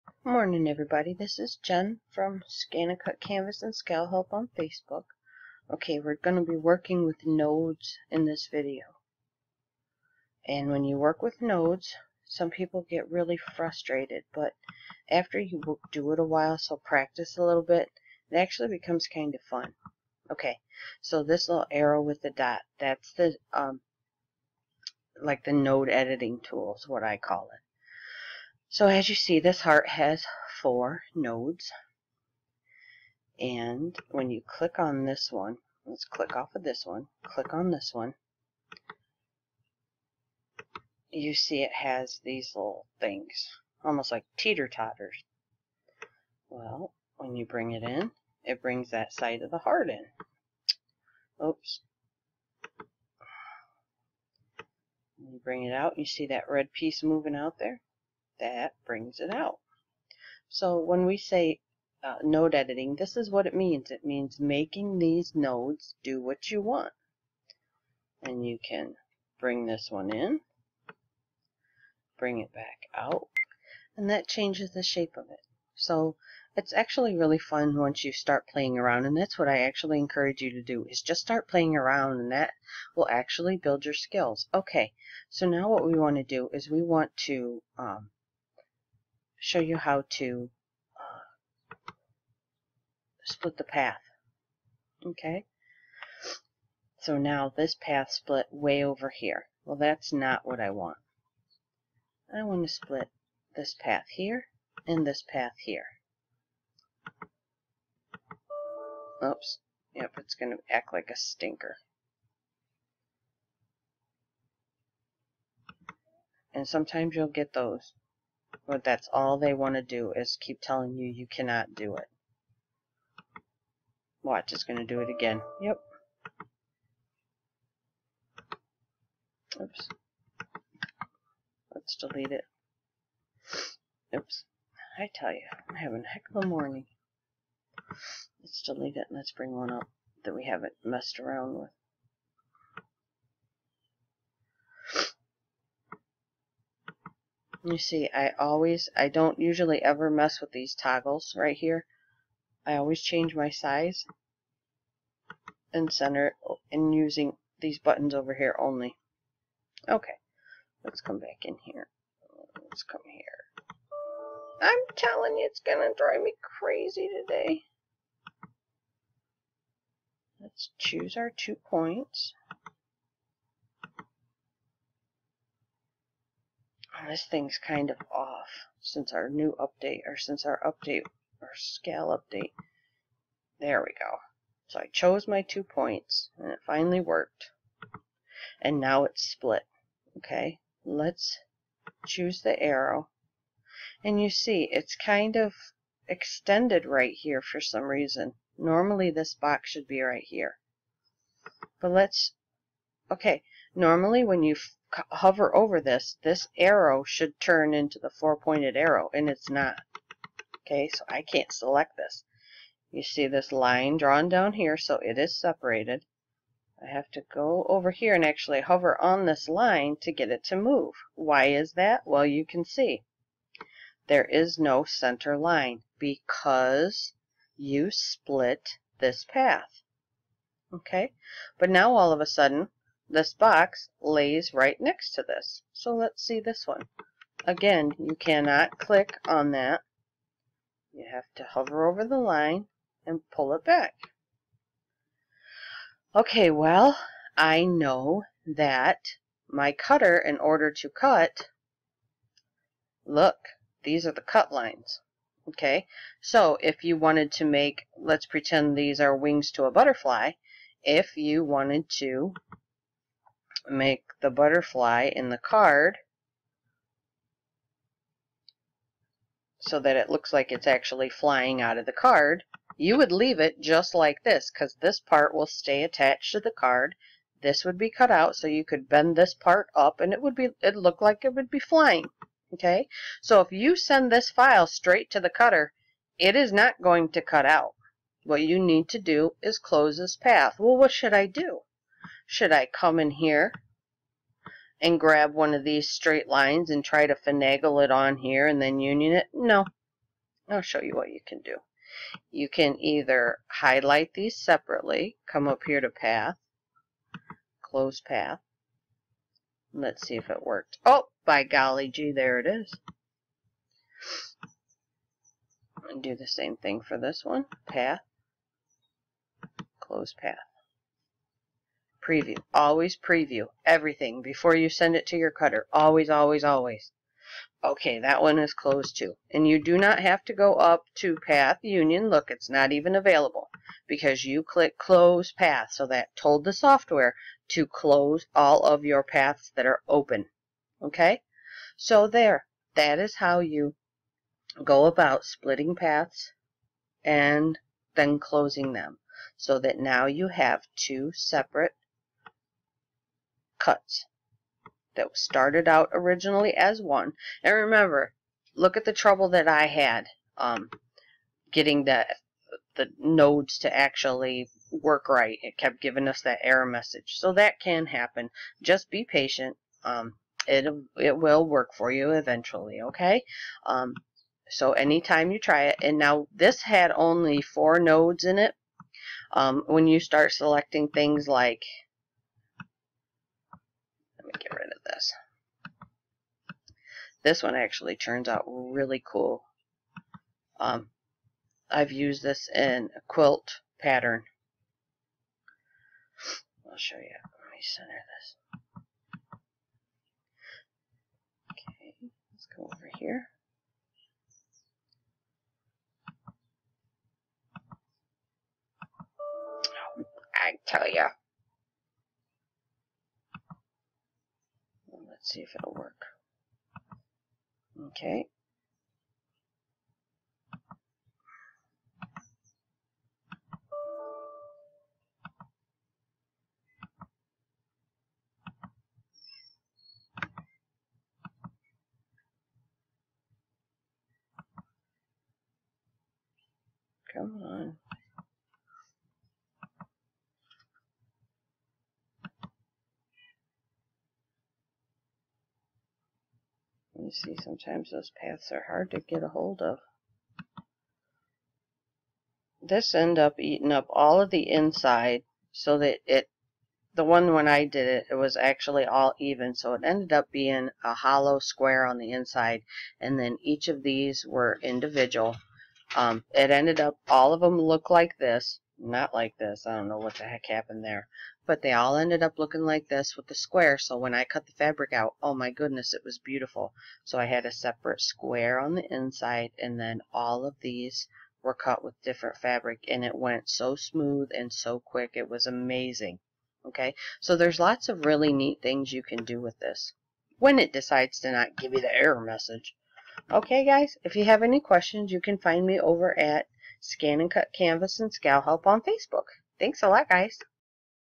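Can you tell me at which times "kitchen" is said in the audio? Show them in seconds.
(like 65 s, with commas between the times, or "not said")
not said.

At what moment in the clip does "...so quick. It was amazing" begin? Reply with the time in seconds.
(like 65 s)
484 s.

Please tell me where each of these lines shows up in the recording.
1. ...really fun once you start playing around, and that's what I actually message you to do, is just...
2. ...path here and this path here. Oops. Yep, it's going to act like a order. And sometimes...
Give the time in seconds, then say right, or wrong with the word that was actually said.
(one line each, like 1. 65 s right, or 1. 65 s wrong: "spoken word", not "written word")
1. 77 s wrong: "encourage", not "message"
2. 103 s wrong: "stinker", not "order".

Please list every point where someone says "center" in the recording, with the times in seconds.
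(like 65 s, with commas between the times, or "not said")
155 s, 224 s, 397 s.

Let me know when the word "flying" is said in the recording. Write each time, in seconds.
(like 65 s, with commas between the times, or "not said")
271 s, 281 s.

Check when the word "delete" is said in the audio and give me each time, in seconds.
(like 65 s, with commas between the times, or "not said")
131 s, 138 s.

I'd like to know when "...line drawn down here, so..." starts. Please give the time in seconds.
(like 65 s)
213 s.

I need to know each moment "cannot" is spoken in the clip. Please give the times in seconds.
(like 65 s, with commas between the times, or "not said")
121 s, 238 s.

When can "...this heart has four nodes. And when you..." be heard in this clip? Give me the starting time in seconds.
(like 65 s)
29 s.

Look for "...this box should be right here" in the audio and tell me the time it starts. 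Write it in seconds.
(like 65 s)
199 s.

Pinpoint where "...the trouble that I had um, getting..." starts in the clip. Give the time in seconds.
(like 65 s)
358 s.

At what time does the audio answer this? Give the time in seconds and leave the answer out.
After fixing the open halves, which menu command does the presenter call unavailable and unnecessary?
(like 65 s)
331 s.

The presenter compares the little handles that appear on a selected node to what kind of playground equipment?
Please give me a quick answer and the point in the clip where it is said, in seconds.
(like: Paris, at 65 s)
Teeter-totters, at 44 s.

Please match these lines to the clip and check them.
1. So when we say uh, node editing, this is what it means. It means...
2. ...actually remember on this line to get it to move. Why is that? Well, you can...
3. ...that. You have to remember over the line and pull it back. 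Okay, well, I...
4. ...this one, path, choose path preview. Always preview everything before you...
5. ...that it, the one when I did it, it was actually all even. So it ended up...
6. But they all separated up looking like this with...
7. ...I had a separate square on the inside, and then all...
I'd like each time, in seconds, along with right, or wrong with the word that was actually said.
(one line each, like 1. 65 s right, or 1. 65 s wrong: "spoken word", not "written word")
1. 60 s right
2. 218 s wrong: "hover", not "remember"
3. 239 s wrong: "hover", not "remember"
4. 316 s wrong: "close", not "choose"
5. 455 s right
6. 471 s wrong: "ended", not "separated"
7. 477 s right.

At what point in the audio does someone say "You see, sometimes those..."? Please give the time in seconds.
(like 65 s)
447 s.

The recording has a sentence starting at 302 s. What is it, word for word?
You can either highlight these separately, come up here to path, close path.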